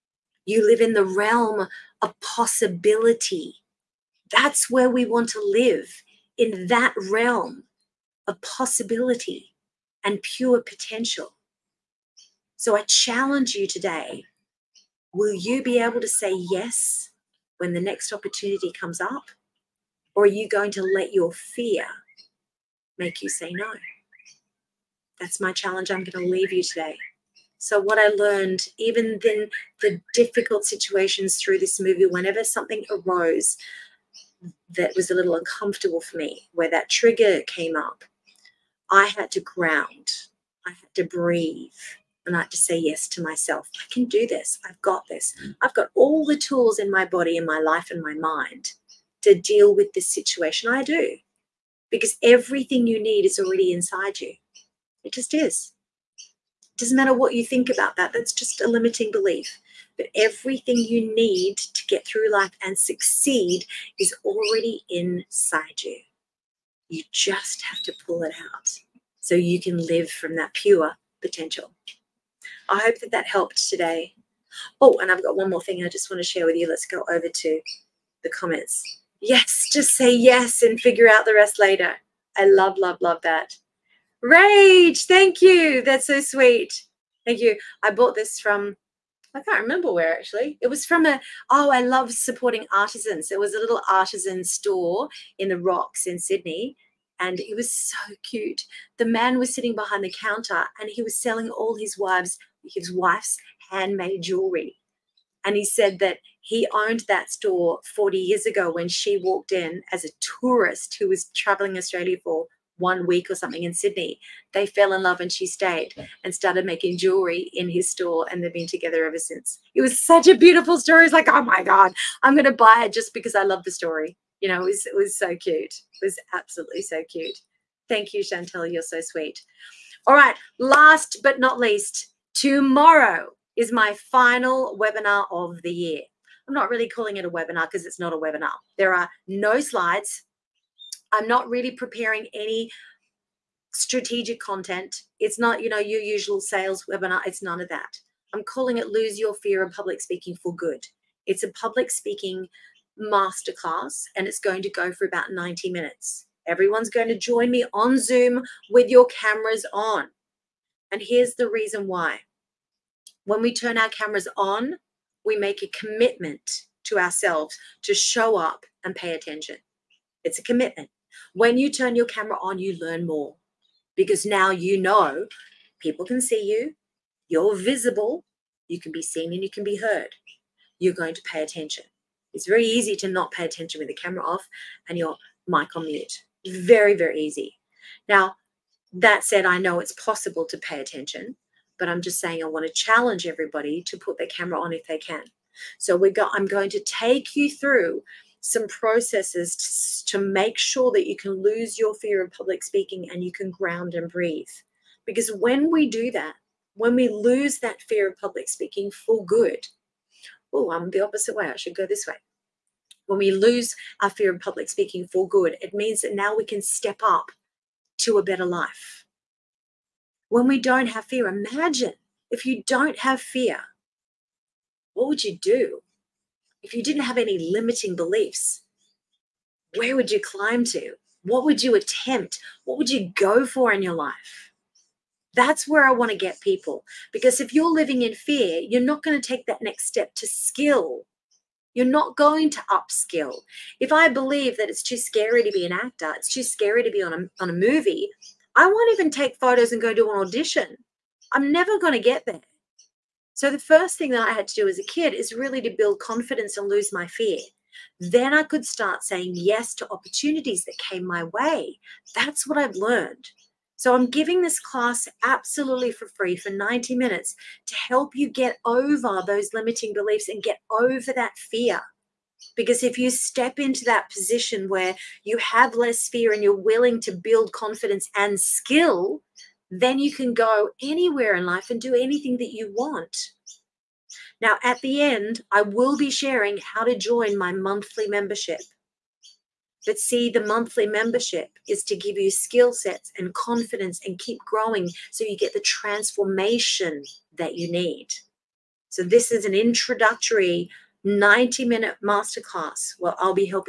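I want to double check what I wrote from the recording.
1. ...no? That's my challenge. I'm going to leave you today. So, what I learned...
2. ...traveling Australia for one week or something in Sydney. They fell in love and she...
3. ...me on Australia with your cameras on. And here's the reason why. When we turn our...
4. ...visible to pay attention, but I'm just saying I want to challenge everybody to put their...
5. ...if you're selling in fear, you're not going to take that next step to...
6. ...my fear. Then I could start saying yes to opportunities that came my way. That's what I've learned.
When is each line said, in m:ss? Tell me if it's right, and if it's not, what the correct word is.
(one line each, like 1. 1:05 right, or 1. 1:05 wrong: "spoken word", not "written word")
1. 0:23 right
2. 1:51 right
3. 2:37 wrong: "Zoom", not "Australia"
4. 3:09 wrong: "possible", not "visible"
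5. 3:57 wrong: "living", not "selling"
6. 4:16 right.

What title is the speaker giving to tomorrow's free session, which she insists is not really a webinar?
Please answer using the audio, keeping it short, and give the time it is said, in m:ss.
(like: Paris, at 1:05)
Lose Your Fear of Public Speaking for Good, at 2:28.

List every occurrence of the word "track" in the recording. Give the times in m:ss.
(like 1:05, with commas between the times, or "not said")
not said.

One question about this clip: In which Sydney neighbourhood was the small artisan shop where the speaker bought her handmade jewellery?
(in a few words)
The Rocks.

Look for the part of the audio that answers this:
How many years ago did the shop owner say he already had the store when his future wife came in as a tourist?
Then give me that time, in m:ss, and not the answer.
1:47.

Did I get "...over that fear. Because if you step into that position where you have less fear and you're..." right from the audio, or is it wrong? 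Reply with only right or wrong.
right.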